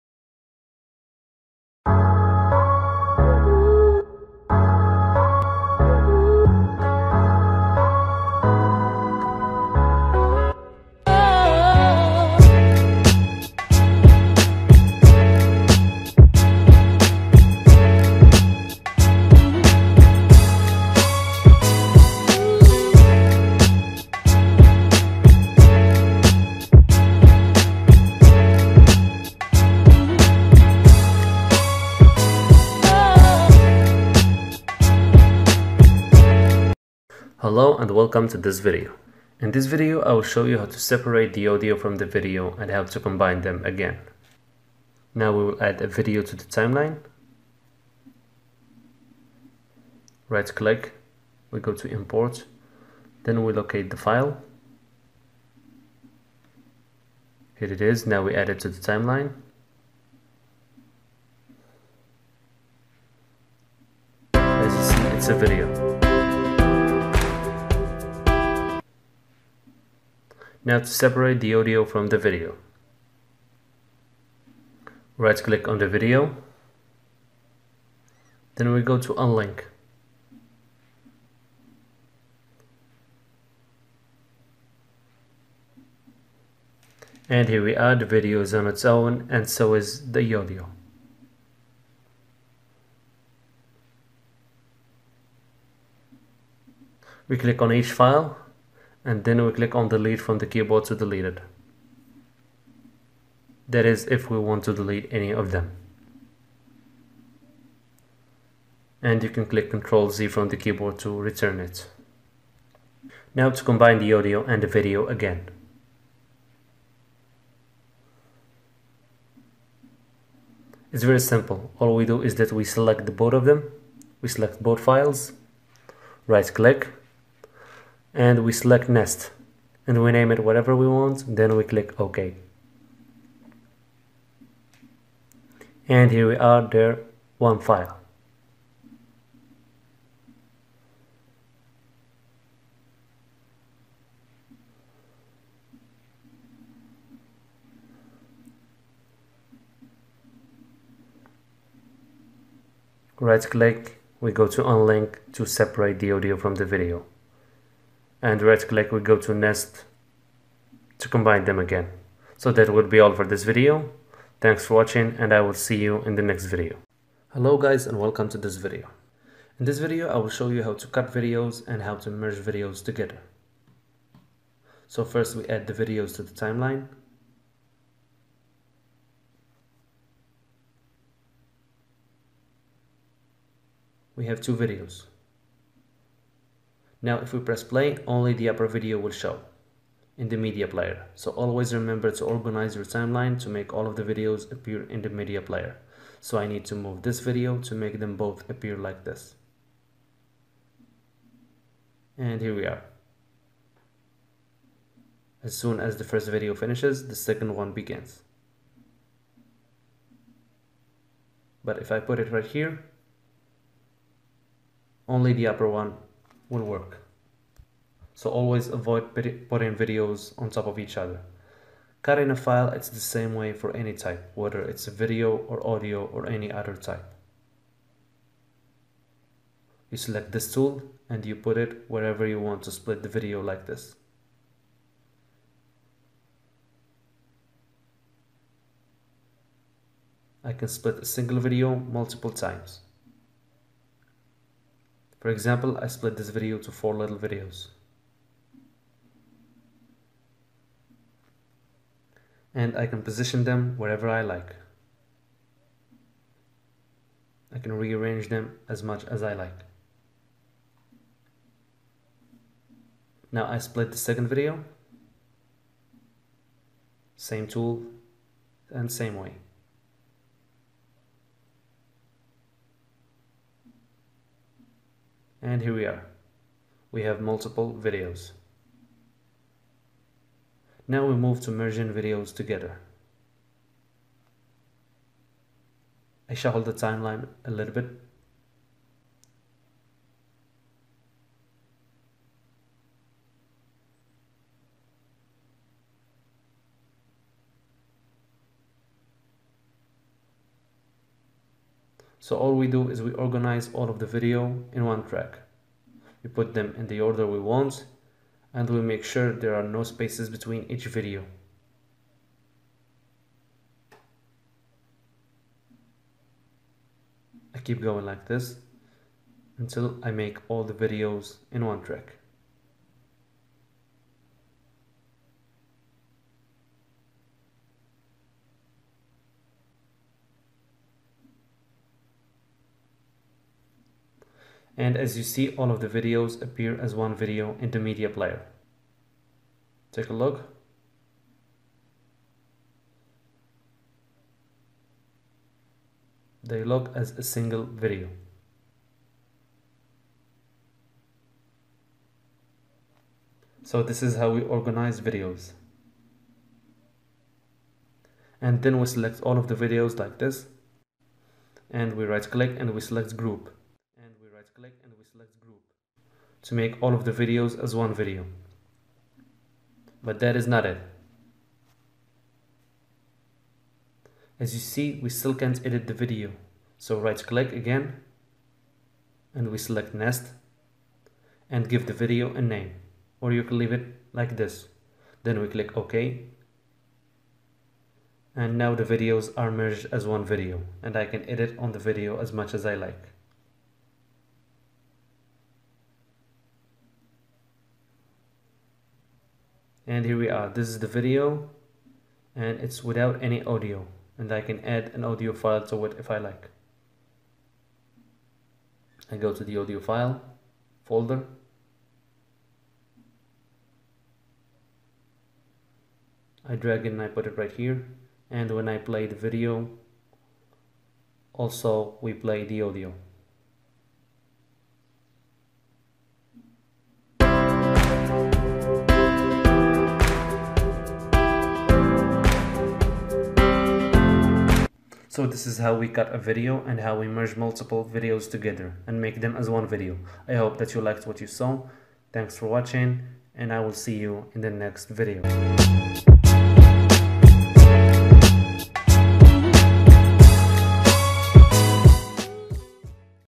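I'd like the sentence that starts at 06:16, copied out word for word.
So right click again and we select nest and give the video a name or you can leave it like this.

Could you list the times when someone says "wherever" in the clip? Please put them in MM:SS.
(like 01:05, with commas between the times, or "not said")
03:51, 04:13.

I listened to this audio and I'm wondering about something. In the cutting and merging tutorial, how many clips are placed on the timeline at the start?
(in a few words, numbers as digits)
2.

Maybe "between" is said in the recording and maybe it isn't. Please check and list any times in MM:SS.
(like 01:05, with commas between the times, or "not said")
05:10.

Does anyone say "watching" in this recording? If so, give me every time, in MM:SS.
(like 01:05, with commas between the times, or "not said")
02:44, 07:22.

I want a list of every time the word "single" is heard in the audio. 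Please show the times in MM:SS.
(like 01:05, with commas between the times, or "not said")
04:01, 05:47.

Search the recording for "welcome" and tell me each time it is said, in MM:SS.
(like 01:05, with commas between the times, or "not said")
00:37, 02:47.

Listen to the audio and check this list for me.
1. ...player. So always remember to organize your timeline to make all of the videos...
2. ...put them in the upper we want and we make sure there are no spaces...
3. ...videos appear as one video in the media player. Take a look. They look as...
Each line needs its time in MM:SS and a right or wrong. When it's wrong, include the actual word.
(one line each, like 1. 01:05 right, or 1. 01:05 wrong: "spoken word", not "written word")
1. 03:10 right
2. 05:06 wrong: "order", not "upper"
3. 05:35 right.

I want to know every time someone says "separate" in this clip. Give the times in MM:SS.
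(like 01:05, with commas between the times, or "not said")
00:40, 01:10, 02:35.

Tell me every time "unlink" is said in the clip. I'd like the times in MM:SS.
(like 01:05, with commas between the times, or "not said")
01:19, 02:34.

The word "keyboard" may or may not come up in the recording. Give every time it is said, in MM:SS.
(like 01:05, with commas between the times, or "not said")
01:40, 01:50.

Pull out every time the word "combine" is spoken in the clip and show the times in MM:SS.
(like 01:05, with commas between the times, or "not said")
00:43, 01:53, 02:41.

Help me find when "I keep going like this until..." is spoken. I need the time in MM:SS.
05:17.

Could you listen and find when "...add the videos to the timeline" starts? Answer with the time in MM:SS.
02:55.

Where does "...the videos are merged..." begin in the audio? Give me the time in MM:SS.
06:28.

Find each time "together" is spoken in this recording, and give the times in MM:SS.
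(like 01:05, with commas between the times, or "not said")
02:52, 04:42, 07:18.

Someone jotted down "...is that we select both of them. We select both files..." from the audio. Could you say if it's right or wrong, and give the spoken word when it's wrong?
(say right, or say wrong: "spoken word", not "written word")
right.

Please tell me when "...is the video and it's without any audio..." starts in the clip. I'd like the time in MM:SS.
06:40.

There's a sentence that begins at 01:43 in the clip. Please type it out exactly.
That is if we want to delete any of them.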